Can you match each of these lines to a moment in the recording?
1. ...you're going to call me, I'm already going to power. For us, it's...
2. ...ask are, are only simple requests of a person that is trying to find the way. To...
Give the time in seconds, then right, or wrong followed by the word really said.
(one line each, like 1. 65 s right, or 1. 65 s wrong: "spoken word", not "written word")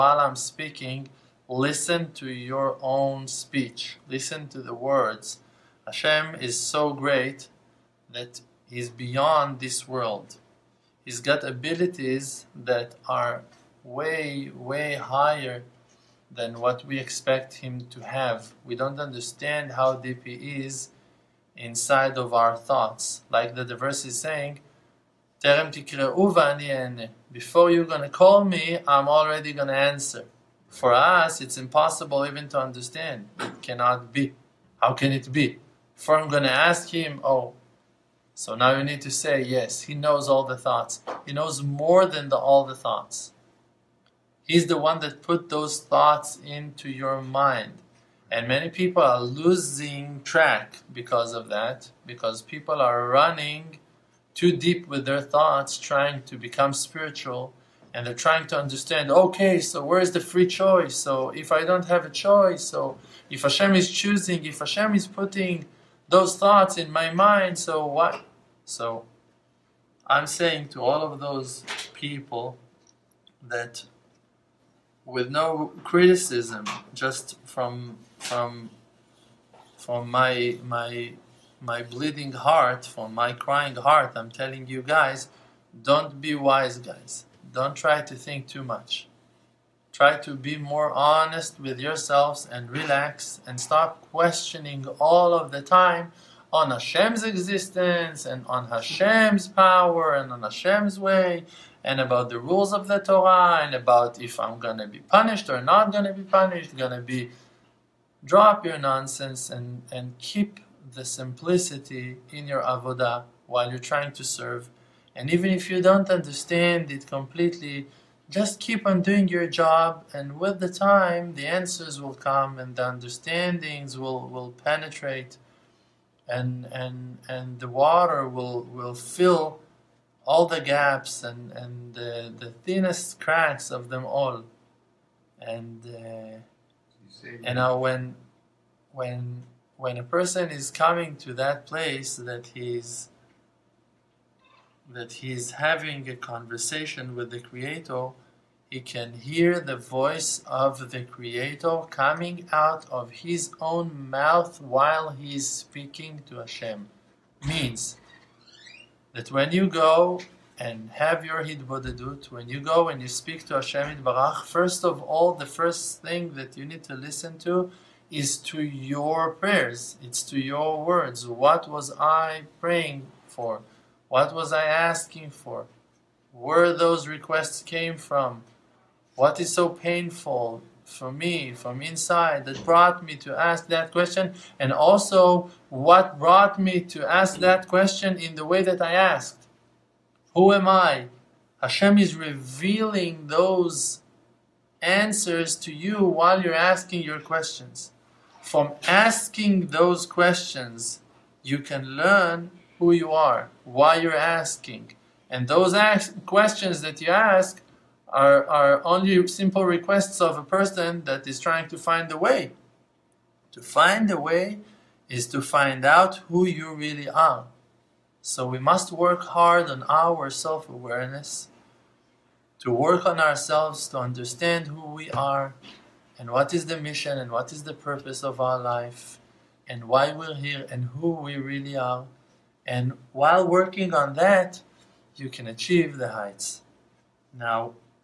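1. 27 s wrong: "answer", not "power"
2. 207 s right.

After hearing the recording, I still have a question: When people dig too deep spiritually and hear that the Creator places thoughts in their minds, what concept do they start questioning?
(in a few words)
free choice.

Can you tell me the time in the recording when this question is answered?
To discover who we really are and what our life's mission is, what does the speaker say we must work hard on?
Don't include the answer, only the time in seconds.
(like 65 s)
220 s.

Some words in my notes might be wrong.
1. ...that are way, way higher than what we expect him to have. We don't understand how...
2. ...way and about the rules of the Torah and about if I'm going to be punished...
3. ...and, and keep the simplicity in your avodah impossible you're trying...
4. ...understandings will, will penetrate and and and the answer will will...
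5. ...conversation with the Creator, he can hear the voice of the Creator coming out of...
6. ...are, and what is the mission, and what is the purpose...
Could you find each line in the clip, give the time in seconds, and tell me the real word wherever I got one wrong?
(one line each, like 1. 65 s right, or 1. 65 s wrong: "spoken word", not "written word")
1. 12 s right
2. 100 s right
3. 109 s wrong: "while", not "impossible"
4. 122 s wrong: "water", not "answer"
5. 146 s right
6. 225 s right.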